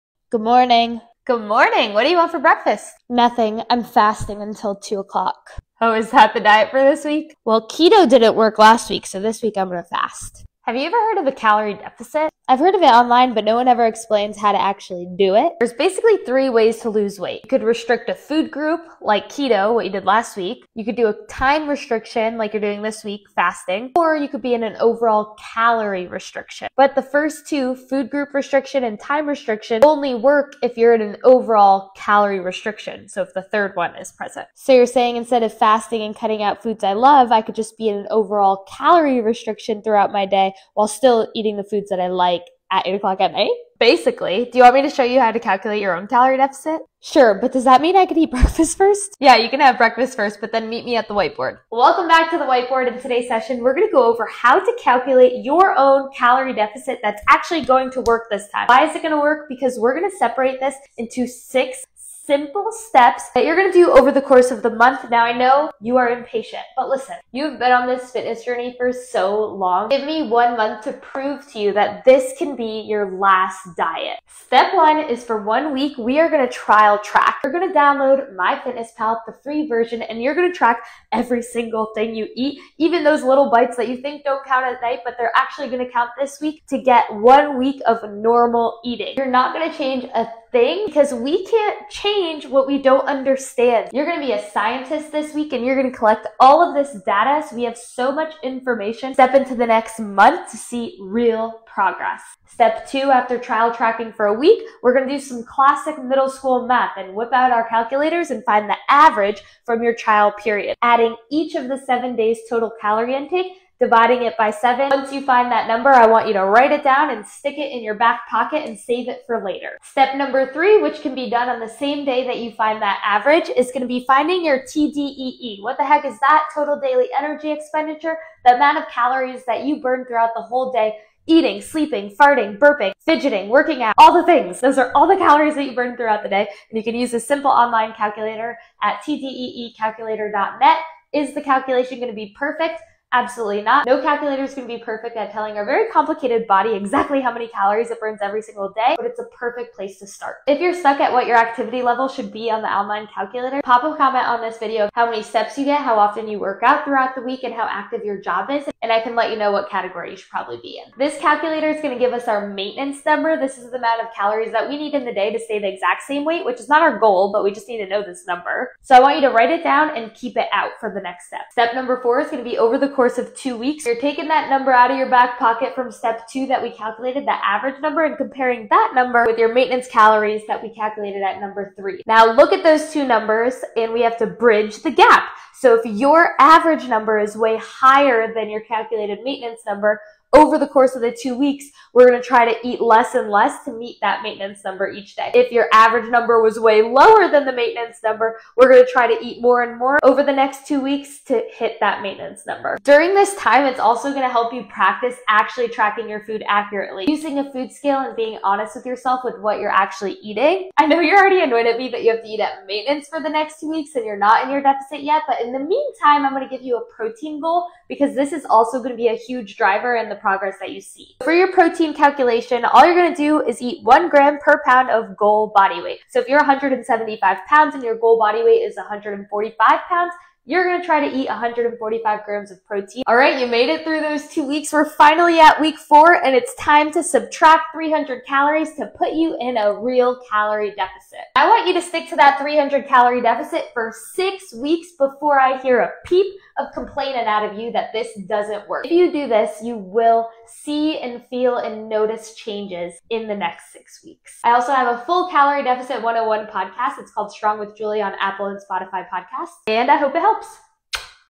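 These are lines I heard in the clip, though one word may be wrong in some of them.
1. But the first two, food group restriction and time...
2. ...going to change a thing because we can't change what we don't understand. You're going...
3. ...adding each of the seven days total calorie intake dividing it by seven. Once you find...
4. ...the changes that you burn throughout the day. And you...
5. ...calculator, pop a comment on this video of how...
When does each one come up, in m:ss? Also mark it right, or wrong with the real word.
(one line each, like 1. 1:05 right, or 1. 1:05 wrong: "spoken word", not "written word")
1. 0:26 right
2. 1:29 right
3. 1:50 right
4. 2:15 wrong: "calories", not "changes"
5. 2:33 right.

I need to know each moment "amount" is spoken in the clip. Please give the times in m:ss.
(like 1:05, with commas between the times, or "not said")
2:08, 2:43.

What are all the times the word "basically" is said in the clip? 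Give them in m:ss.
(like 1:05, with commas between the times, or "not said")
0:15, 0:43.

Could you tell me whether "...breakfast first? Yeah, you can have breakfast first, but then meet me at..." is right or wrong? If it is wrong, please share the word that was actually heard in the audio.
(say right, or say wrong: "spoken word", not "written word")
right.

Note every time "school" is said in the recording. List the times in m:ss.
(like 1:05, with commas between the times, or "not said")
1:46.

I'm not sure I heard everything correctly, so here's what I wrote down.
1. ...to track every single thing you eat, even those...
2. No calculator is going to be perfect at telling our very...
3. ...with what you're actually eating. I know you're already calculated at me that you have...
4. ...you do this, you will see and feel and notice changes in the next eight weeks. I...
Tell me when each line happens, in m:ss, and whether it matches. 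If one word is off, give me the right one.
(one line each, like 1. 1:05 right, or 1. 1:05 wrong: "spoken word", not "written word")
1. 1:20 right
2. 2:23 right
3. 3:29 wrong: "annoyed", not "calculated"
4. 4:08 wrong: "six", not "eight".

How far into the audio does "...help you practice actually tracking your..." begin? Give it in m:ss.
3:24.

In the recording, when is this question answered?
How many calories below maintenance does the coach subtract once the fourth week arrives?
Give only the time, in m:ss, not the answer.
3:57.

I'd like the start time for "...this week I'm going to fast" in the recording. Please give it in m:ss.
0:09.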